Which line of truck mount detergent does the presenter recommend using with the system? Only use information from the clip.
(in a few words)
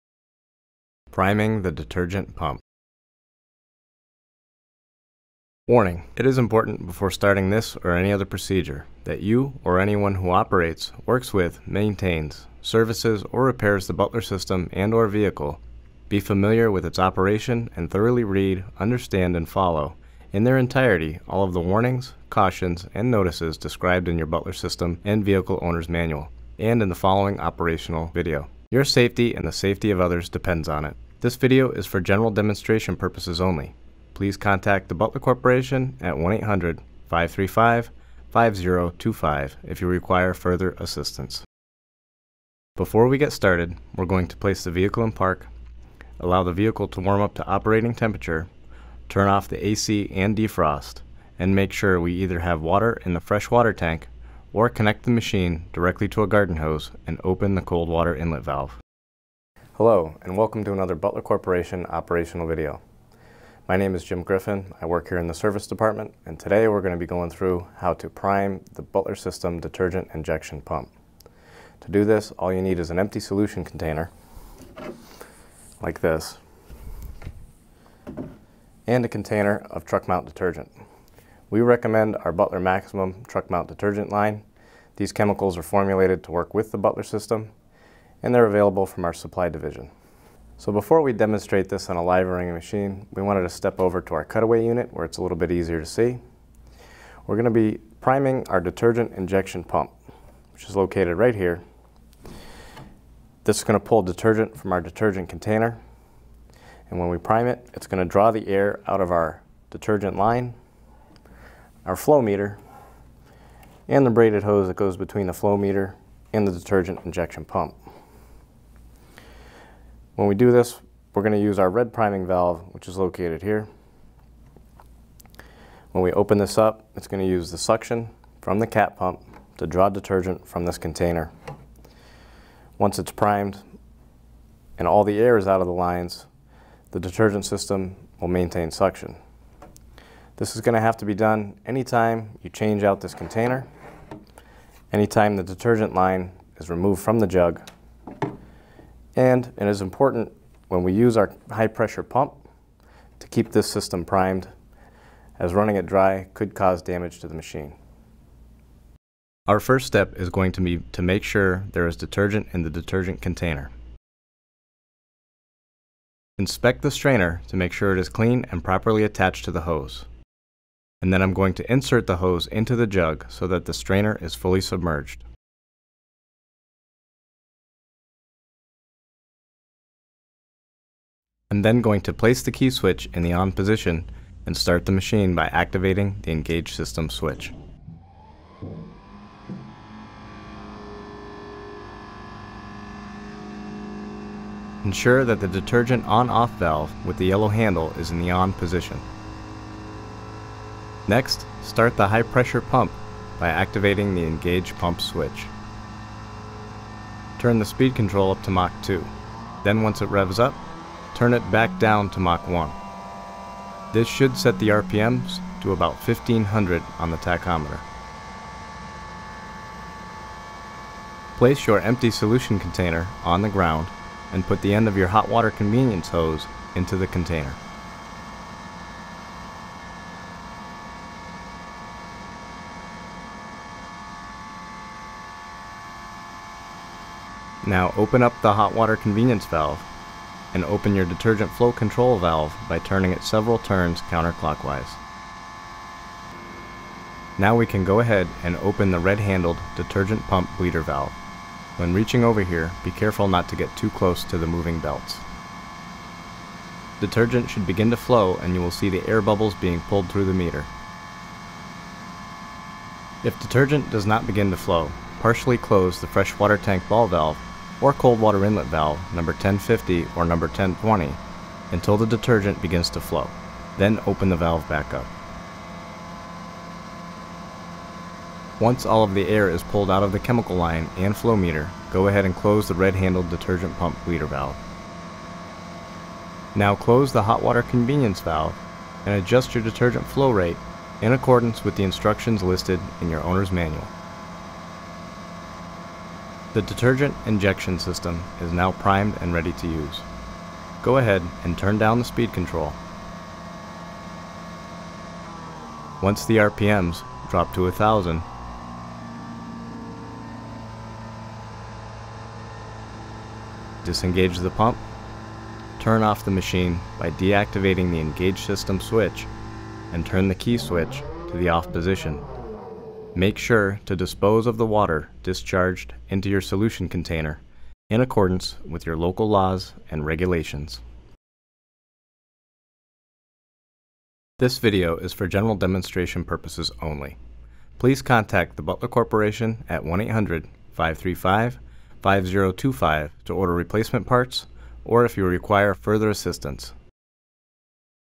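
Butler Maximum.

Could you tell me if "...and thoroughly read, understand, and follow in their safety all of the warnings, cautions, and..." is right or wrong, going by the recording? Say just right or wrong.
wrong.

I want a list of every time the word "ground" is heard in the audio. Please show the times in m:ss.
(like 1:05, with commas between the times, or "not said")
3:43.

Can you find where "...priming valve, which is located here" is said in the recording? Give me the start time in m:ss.
2:01.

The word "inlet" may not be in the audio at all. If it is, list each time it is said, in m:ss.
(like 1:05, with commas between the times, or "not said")
0:58, 4:28.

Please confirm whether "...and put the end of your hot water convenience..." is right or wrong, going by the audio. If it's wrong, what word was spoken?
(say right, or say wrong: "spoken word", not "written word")
right.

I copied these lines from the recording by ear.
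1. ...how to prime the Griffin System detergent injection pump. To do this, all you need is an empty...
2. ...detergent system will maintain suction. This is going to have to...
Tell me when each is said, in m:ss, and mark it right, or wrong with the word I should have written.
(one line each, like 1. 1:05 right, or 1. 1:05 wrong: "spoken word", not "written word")
1. 1:07 wrong: "Butler", not "Griffin"
2. 2:16 right.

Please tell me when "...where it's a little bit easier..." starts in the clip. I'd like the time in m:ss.
1:34.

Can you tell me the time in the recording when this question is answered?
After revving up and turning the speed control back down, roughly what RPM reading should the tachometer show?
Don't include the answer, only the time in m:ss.
3:35.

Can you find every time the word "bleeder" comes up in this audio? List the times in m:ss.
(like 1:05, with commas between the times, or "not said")
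4:10, 4:44.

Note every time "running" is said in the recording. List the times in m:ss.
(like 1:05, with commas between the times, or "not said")
1:32, 2:35.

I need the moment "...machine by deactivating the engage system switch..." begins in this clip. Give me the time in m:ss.
5:16.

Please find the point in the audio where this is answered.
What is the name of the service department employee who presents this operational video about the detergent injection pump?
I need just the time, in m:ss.
1:04.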